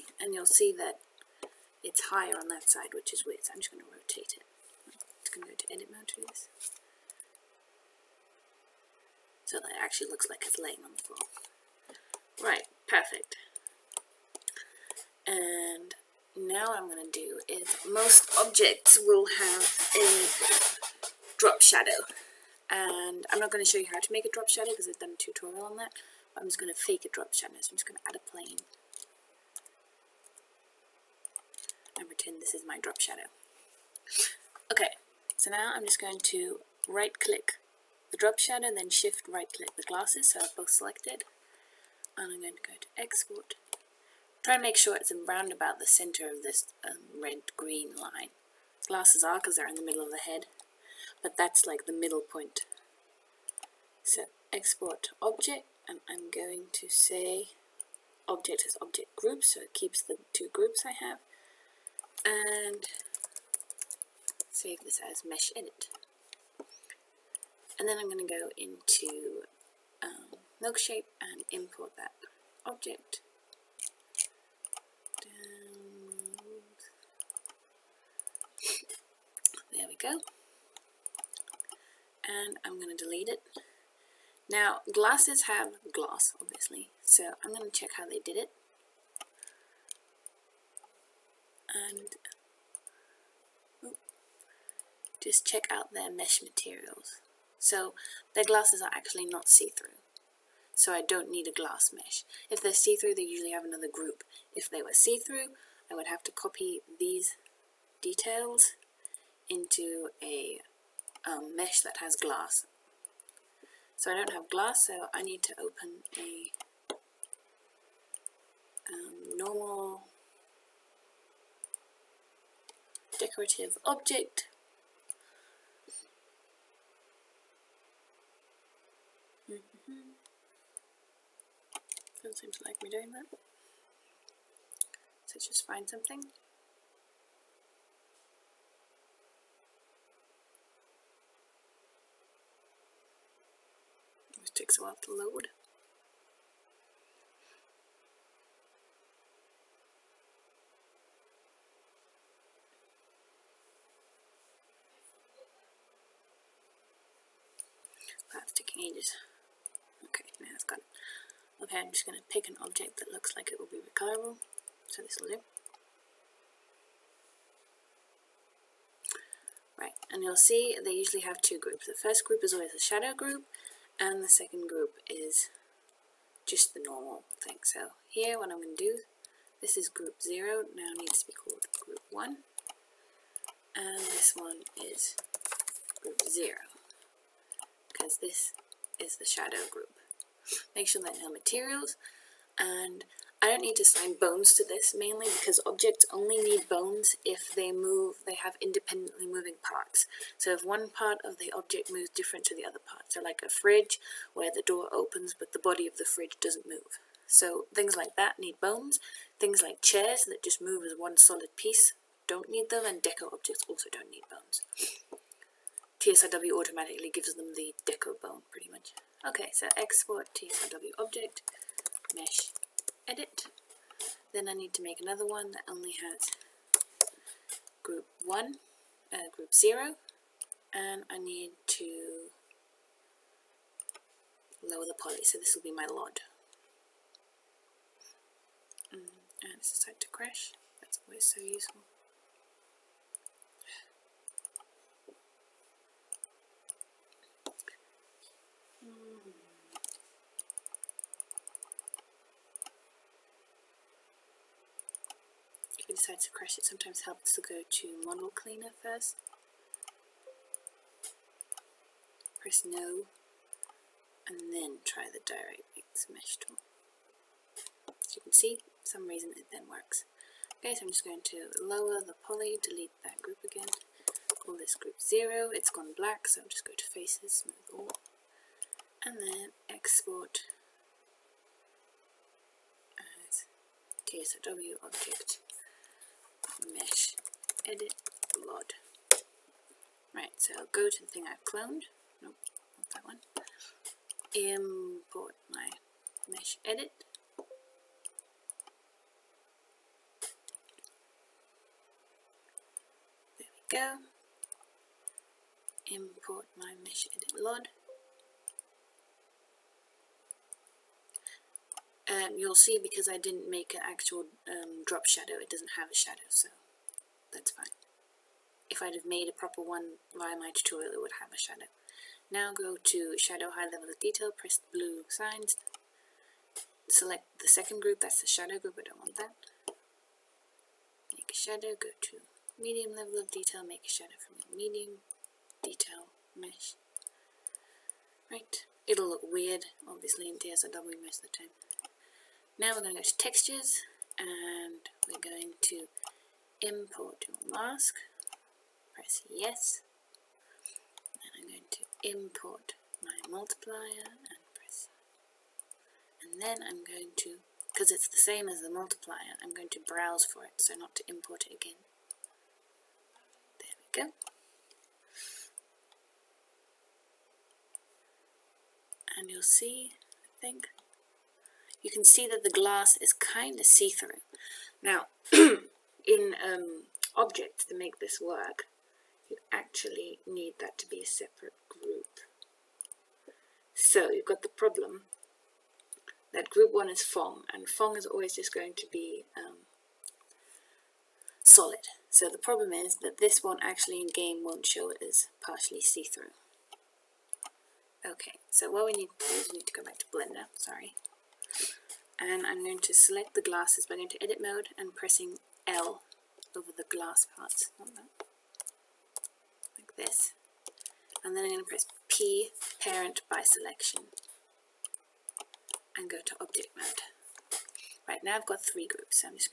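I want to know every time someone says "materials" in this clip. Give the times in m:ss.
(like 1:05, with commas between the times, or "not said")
1:36, 3:11.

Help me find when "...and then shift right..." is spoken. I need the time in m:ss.
0:38.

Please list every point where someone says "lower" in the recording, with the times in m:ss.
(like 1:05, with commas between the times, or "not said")
3:54, 4:31.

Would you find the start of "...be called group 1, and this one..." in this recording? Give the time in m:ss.
3:01.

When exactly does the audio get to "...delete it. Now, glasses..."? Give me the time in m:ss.
1:23.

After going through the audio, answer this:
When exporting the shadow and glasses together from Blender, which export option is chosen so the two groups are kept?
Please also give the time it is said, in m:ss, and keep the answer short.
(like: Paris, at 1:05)
Object as object group, at 0:58.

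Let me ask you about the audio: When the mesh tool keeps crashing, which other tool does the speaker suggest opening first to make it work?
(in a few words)
model cleaner.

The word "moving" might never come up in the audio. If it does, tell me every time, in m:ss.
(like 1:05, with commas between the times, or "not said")
3:19.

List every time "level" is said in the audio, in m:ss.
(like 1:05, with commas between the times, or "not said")
5:23, 5:32.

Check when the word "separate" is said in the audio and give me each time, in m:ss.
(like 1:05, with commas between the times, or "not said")
6:21.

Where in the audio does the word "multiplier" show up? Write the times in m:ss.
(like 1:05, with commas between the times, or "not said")
5:53, 5:58.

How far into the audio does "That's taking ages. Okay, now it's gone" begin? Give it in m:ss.
2:38.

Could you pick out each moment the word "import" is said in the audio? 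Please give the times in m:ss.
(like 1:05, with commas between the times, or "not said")
1:11, 4:54, 5:05, 5:46, 5:52, 6:01.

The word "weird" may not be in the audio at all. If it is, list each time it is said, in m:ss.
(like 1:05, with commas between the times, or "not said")
0:03, 5:39.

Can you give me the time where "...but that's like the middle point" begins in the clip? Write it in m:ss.
0:51.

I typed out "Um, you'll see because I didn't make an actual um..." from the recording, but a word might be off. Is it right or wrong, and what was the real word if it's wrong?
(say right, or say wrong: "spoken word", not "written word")
right.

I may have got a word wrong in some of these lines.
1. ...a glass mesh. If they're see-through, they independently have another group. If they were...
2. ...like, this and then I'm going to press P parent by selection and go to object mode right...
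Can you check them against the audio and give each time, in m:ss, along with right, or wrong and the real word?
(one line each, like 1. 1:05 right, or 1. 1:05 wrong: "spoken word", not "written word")
1. 1:41 wrong: "usually", not "independently"
2. 6:47 right.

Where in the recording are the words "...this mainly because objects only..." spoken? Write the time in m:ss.
3:14.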